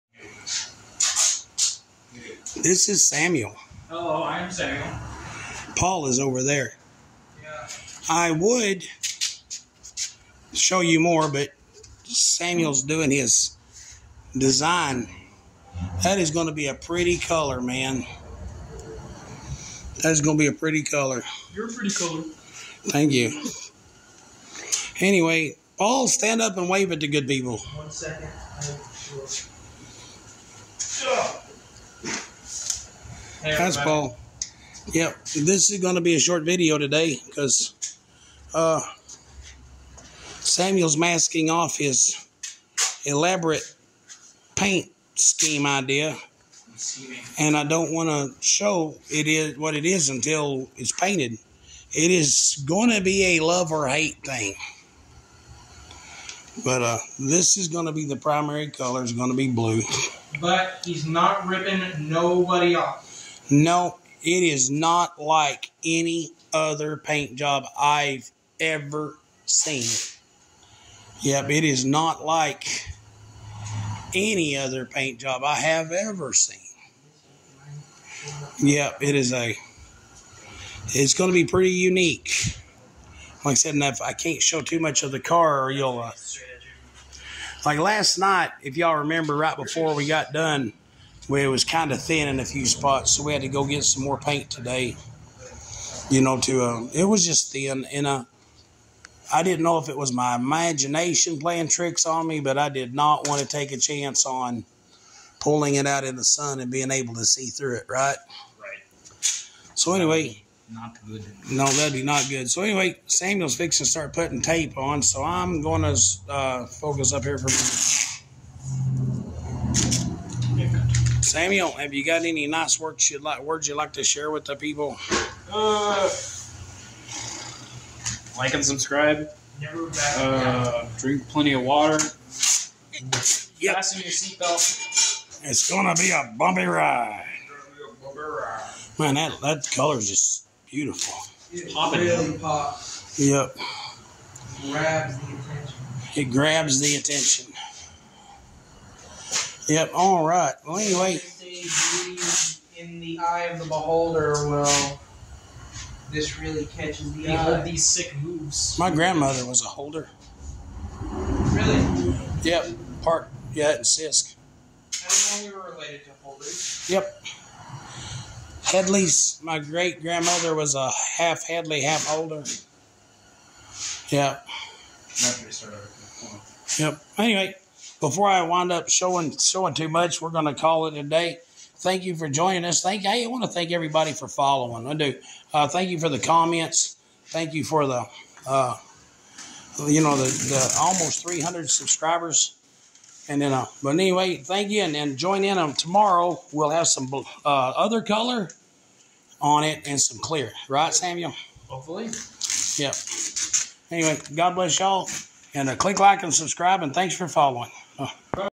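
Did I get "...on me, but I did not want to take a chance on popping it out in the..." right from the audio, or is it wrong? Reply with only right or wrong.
wrong.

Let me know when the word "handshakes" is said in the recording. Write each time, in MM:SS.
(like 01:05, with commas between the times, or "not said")
not said.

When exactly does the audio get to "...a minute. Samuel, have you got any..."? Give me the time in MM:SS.
01:57.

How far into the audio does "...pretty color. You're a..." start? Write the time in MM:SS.
00:20.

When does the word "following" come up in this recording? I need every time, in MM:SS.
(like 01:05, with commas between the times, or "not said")
03:04, 03:27.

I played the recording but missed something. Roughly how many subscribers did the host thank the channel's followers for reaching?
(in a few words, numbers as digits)
almost 300.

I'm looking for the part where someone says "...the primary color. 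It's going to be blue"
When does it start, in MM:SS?
00:58.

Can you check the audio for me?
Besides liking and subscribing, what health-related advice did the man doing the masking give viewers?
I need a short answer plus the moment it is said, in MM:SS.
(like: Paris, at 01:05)
drink plenty of water, at 02:10.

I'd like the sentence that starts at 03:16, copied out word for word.
We'll have some uh, other color on it and some clear, right, Samuel?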